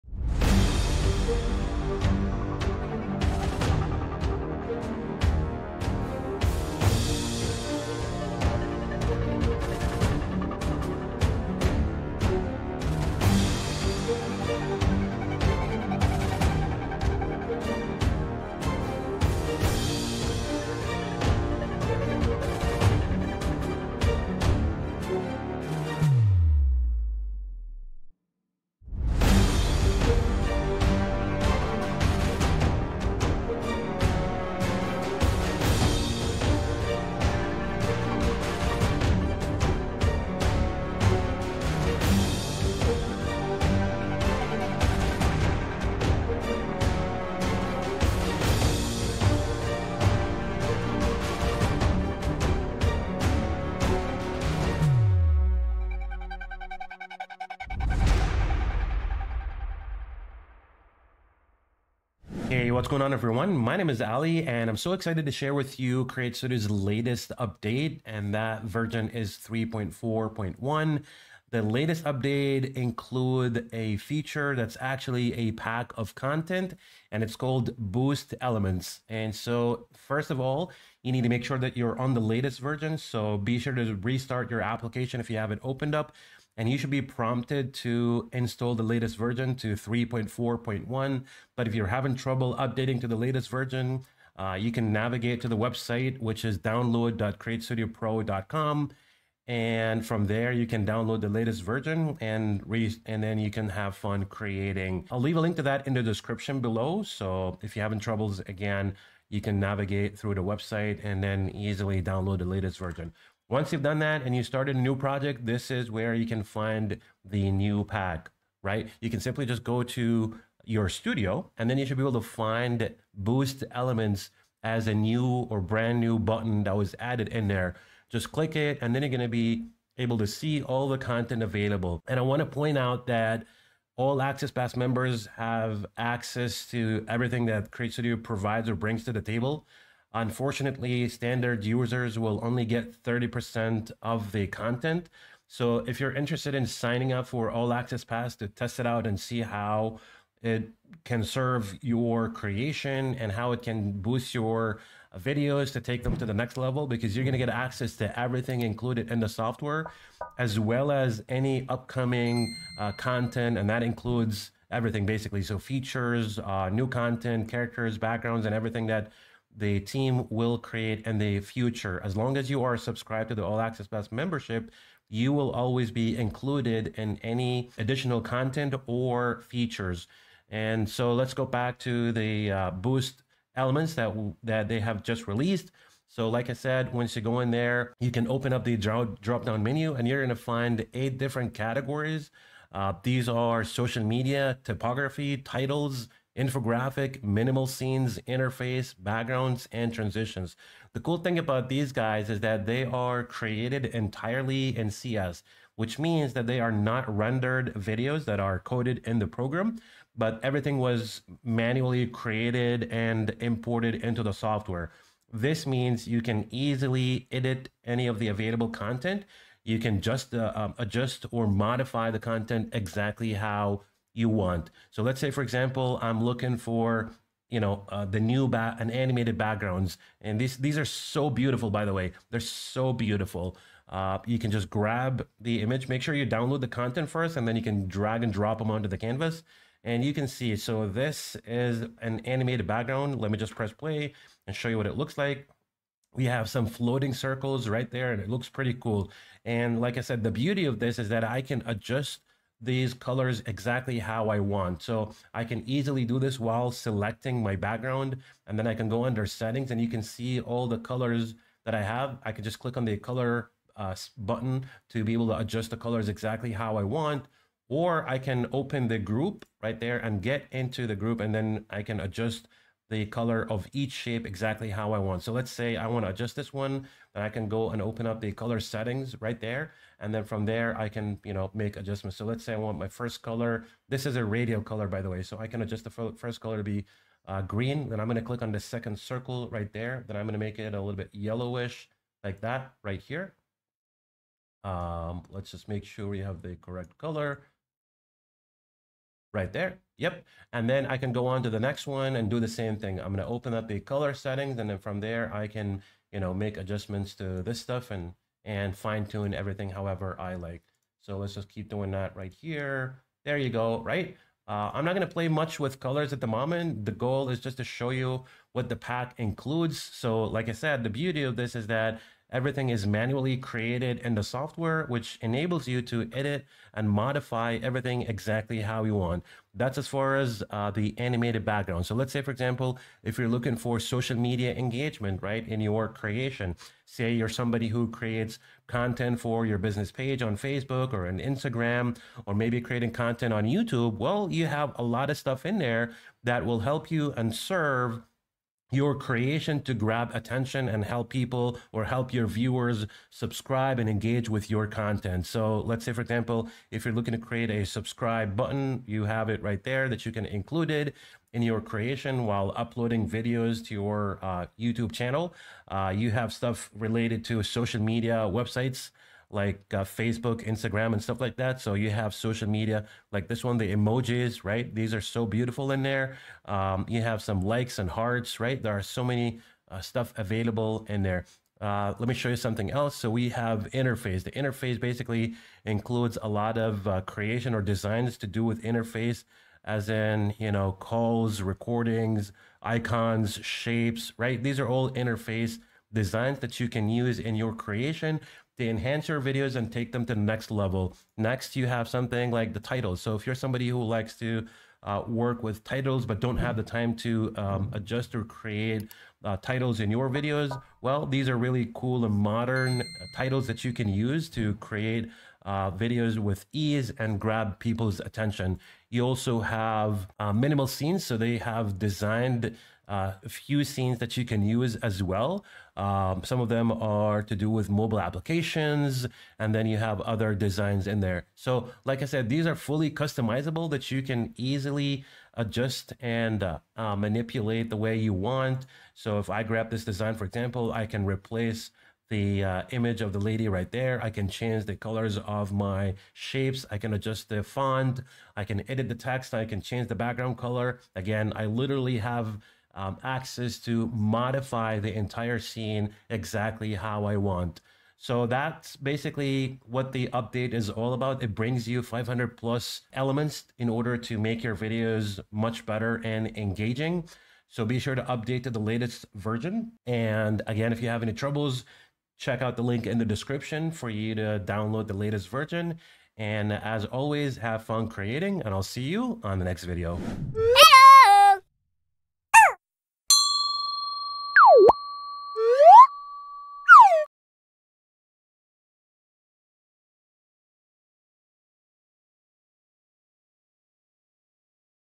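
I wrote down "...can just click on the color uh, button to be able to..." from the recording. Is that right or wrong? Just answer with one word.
right.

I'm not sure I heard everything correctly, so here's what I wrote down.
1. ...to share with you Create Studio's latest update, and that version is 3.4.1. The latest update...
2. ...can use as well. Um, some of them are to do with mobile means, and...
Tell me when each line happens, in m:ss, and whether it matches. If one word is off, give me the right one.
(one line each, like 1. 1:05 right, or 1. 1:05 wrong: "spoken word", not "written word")
1. 1:05 right
2. 7:04 wrong: "applications", not "means".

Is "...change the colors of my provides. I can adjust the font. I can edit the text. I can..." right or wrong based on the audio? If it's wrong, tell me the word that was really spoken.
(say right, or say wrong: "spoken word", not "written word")
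wrong: "shapes", not "provides".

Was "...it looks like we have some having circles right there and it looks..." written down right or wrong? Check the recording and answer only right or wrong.
wrong.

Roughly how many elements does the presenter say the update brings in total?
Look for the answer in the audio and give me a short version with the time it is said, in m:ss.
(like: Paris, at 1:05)
500+, at 7:41.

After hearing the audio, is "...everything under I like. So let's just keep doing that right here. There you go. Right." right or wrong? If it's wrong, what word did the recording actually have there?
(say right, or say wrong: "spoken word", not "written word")
wrong: "however", not "under".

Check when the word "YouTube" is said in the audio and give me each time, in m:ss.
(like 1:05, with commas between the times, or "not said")
5:43, 6:04.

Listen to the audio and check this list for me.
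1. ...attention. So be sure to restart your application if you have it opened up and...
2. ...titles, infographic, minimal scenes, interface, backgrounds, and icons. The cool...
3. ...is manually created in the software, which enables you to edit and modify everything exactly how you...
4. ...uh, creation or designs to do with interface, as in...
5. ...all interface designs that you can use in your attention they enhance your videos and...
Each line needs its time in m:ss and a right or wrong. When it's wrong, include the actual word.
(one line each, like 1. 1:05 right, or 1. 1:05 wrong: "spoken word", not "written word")
1. 1:22 wrong: "version", not "attention"
2. 3:15 wrong: "transitions", not "icons"
3. 5:22 right
4. 6:26 right
5. 6:34 wrong: "creation", not "attention".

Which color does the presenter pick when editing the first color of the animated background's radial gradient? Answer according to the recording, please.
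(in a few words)
green.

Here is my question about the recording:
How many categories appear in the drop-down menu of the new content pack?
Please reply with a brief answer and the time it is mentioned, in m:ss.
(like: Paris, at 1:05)
eight, at 3:10.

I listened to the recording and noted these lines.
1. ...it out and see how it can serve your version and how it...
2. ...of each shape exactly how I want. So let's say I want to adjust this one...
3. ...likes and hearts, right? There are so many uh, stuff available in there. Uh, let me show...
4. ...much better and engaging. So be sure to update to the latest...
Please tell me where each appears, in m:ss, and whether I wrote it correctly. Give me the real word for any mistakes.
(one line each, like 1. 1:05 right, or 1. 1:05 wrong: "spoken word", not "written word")
1. 2:28 wrong: "creation", not "version"
2. 4:33 right
3. 6:17 right
4. 7:45 right.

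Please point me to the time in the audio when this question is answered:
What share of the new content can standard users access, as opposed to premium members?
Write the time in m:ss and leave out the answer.
2:23.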